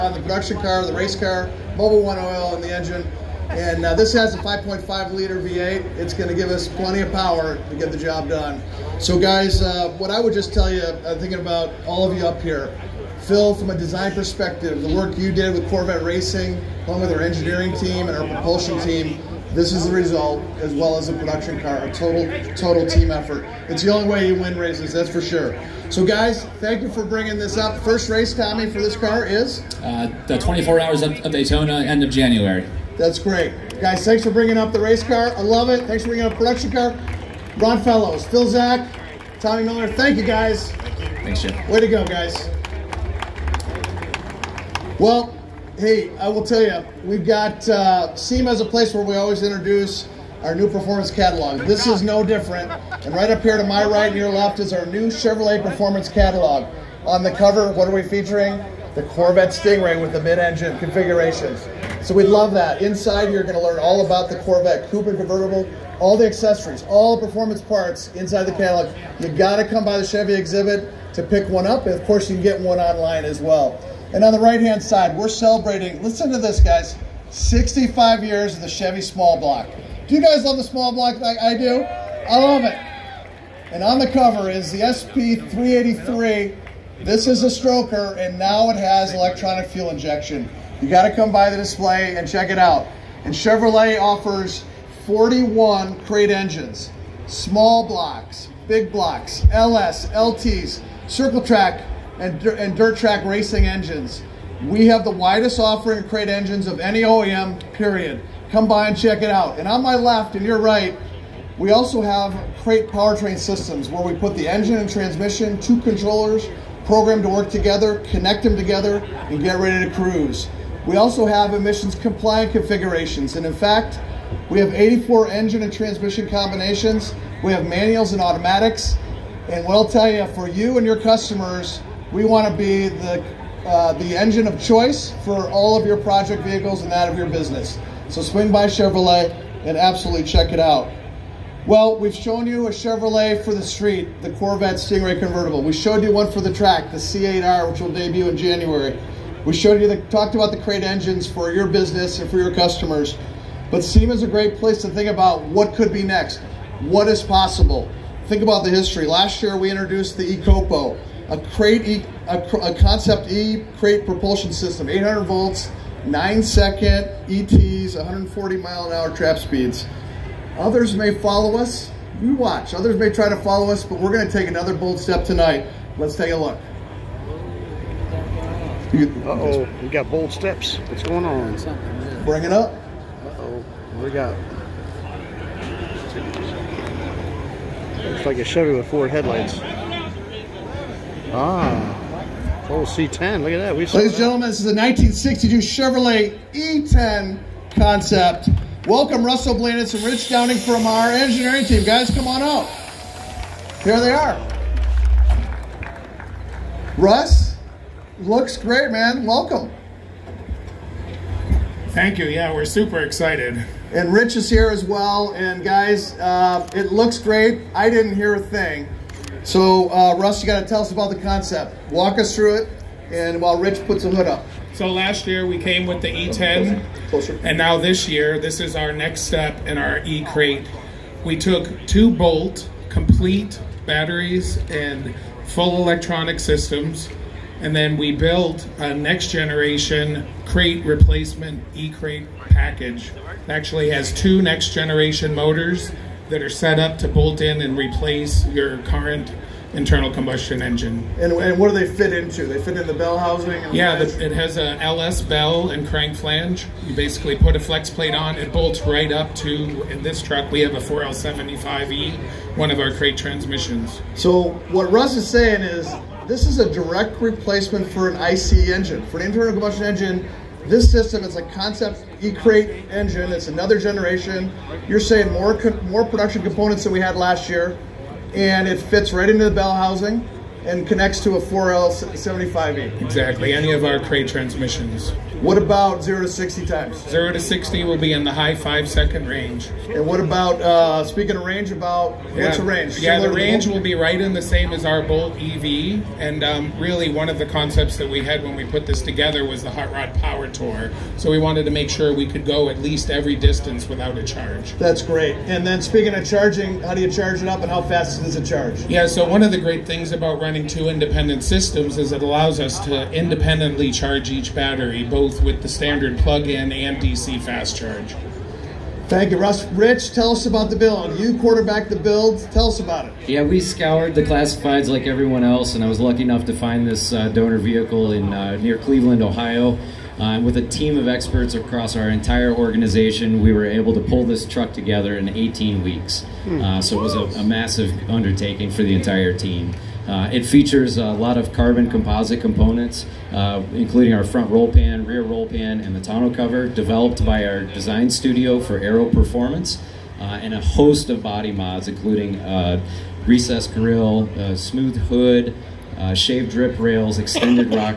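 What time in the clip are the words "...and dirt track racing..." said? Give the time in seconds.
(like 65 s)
102 s.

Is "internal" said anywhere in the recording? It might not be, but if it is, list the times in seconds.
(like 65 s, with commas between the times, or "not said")
249 s, 269 s.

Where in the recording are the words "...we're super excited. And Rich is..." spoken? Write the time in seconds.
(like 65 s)
212 s.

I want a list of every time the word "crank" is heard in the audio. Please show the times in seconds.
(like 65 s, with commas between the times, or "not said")
255 s.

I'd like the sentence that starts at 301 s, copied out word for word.
So we wanted to make sure we could go at least every distance without a charge.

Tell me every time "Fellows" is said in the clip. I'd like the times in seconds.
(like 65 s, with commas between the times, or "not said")
37 s.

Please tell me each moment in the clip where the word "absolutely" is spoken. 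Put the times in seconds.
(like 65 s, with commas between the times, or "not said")
139 s.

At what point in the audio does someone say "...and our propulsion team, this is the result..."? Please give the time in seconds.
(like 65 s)
18 s.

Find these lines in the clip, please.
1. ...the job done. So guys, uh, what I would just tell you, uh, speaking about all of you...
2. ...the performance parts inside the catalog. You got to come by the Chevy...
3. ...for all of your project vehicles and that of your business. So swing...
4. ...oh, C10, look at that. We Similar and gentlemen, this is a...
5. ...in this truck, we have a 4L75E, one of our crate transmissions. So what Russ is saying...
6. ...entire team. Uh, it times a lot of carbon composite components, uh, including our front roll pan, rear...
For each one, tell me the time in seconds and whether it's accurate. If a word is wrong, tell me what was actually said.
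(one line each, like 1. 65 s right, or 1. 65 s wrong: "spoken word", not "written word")
1. 7 s wrong: "thinking", not "speaking"
2. 67 s right
3. 135 s right
4. 192 s wrong: "Ladies", not "Similar"
5. 259 s right
6. 338 s wrong: "features", not "times".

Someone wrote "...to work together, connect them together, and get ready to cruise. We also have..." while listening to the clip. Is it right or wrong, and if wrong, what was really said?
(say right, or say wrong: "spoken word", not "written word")
right.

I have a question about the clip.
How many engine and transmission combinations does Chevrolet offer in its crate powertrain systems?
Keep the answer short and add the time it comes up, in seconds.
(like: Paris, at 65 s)
84, at 124 s.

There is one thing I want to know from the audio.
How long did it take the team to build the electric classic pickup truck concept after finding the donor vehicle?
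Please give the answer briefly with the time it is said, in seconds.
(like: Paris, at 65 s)
18 weeks, at 335 s.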